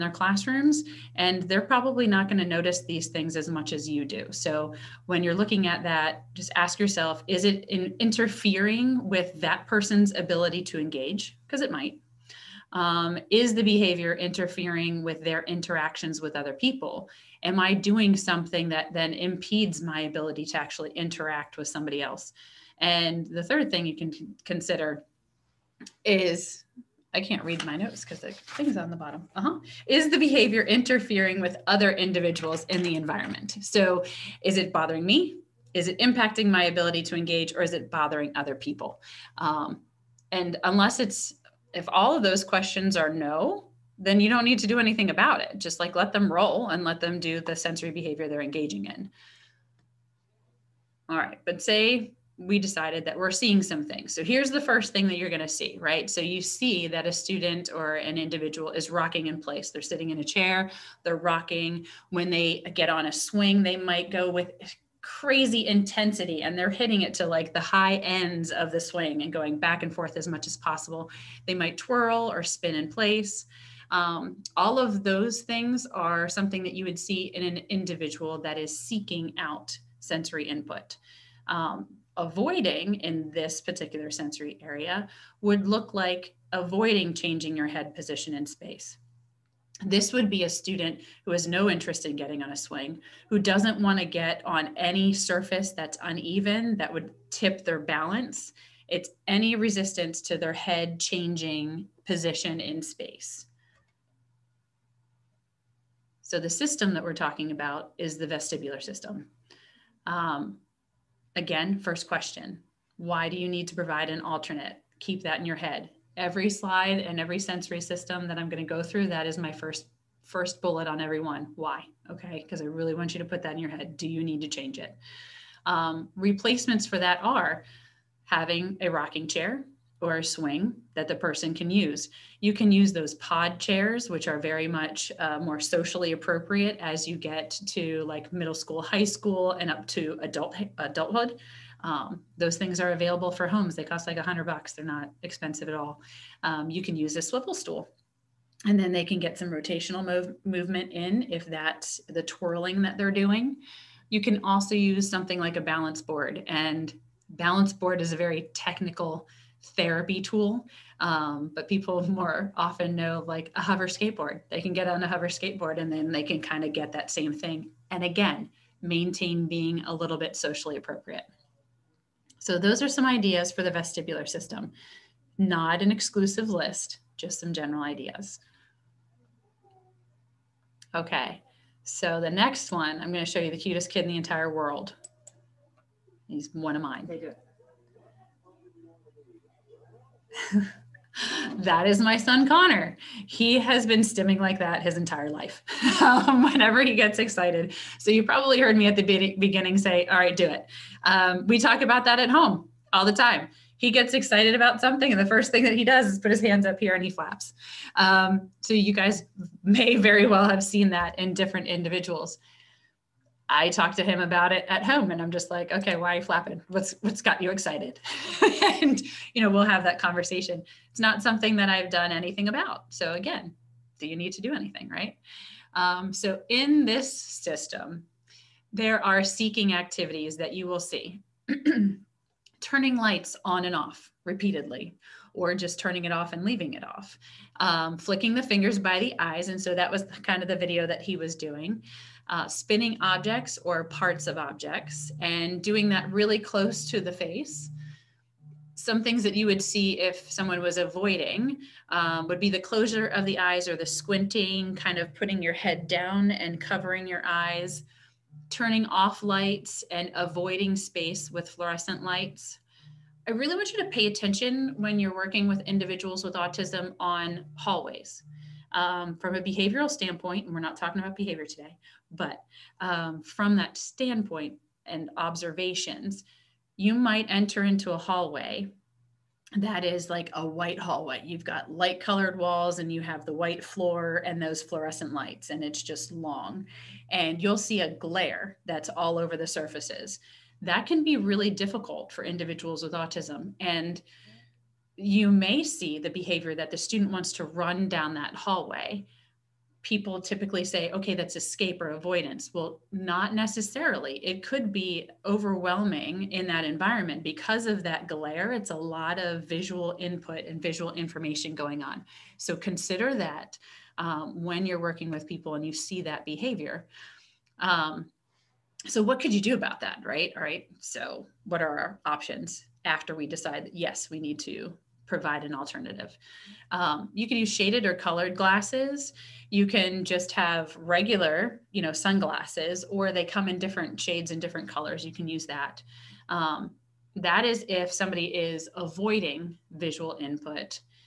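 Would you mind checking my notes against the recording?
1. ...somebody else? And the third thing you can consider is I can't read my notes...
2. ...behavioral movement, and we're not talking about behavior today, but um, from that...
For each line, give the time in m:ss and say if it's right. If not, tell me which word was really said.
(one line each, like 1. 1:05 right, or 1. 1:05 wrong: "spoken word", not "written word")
1. 0:21 right
2. 4:29 wrong: "standpoint", not "movement".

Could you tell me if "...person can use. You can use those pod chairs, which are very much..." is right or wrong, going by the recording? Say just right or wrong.
right.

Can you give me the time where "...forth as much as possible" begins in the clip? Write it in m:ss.
1:09.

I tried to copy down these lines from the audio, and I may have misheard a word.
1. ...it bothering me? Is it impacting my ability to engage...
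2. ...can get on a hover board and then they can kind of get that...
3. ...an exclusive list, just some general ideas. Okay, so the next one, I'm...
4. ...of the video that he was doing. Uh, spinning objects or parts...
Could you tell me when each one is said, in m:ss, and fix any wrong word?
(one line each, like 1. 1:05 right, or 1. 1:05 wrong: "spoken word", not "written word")
1. 0:34 right
2. 2:44 wrong: "skateboard", not "board"
3. 2:55 right
4. 4:00 right.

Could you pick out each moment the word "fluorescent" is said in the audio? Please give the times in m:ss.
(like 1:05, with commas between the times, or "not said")
4:21, 4:44.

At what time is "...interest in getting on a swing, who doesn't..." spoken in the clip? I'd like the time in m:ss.
1:31.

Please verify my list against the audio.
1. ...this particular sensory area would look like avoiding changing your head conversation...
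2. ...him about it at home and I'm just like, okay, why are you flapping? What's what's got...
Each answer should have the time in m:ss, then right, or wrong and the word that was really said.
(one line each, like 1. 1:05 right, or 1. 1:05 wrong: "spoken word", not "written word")
1. 1:23 wrong: "position", not "conversation"
2. 3:34 right.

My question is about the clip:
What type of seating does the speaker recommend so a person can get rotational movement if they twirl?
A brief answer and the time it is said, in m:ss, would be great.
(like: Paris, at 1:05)
swivel stool, at 2:27.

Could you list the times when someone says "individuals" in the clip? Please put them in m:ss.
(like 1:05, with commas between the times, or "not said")
0:31, 0:58, 1:17, 3:31, 4:25, 4:52.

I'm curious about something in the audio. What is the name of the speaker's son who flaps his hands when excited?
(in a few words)
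Connor.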